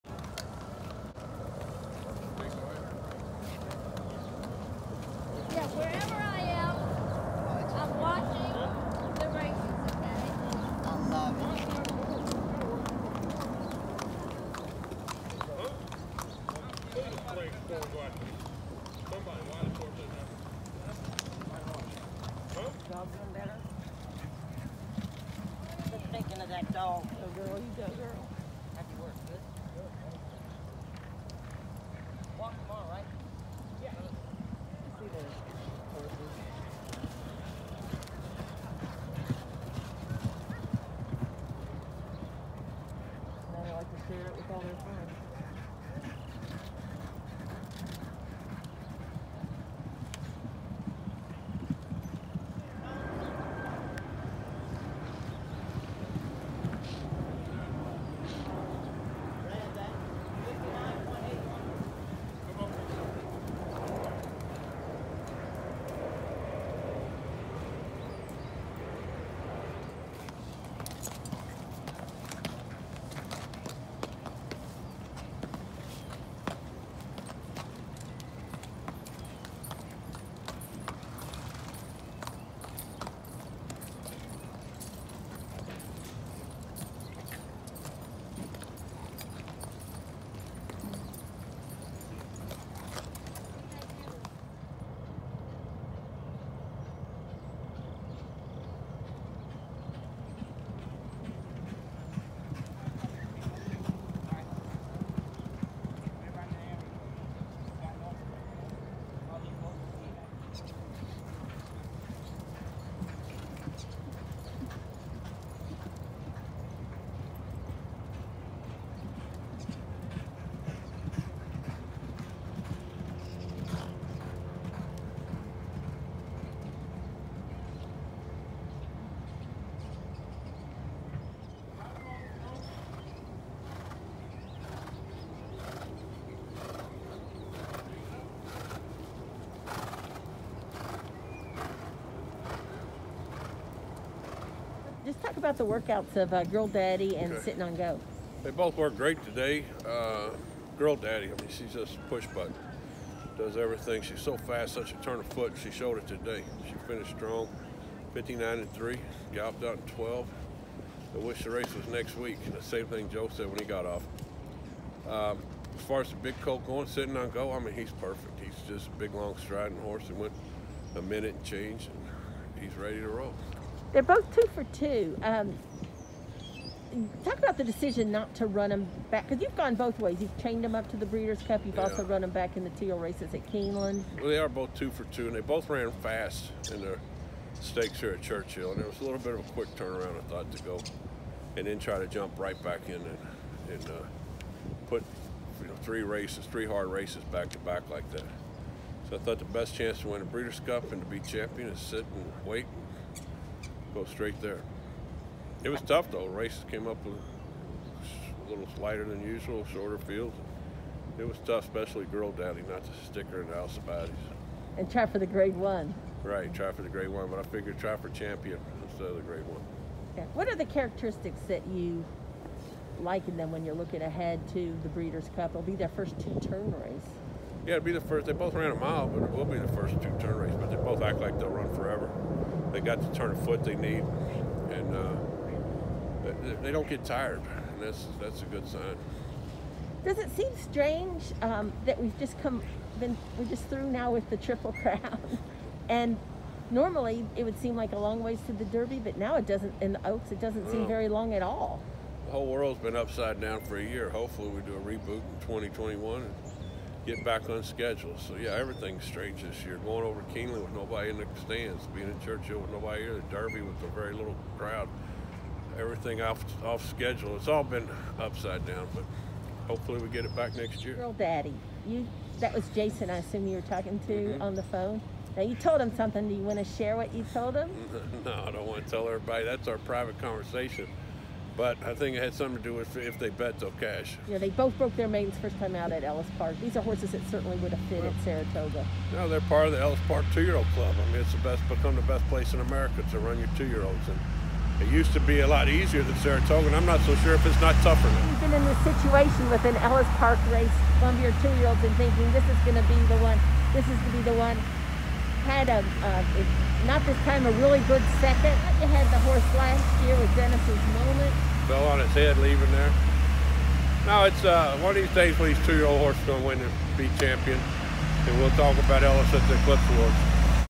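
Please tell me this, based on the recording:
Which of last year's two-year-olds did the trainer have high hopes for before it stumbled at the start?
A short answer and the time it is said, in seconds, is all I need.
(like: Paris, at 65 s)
Genesis Moment, at 310 s.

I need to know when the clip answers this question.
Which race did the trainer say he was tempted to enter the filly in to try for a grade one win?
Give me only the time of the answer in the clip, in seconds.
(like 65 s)
213 s.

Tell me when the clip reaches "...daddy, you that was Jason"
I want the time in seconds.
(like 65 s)
271 s.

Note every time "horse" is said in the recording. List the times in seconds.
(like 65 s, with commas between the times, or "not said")
169 s, 286 s, 309 s, 315 s.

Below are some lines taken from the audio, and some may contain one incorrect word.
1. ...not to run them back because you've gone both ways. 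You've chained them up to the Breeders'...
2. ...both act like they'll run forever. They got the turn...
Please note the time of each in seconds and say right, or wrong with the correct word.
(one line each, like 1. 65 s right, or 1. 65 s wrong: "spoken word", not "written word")
1. 178 s right
2. 230 s right.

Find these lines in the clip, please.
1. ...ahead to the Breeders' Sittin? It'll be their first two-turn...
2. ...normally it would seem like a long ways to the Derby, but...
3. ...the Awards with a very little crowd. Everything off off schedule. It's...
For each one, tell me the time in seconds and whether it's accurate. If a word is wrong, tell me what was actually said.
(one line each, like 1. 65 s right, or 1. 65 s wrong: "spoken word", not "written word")
1. 224 s wrong: "Cup", not "Sittin"
2. 246 s right
3. 263 s wrong: "Derby", not "Awards".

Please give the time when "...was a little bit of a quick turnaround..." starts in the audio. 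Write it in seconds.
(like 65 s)
188 s.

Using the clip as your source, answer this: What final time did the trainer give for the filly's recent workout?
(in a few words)
59 and 3.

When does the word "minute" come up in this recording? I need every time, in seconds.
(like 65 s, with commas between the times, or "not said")
171 s.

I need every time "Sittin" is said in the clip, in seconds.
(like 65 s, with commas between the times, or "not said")
147 s, 166 s.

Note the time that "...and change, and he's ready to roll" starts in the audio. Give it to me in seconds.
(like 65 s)
171 s.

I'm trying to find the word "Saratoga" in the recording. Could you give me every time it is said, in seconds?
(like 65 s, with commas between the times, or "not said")
288 s, 296 s.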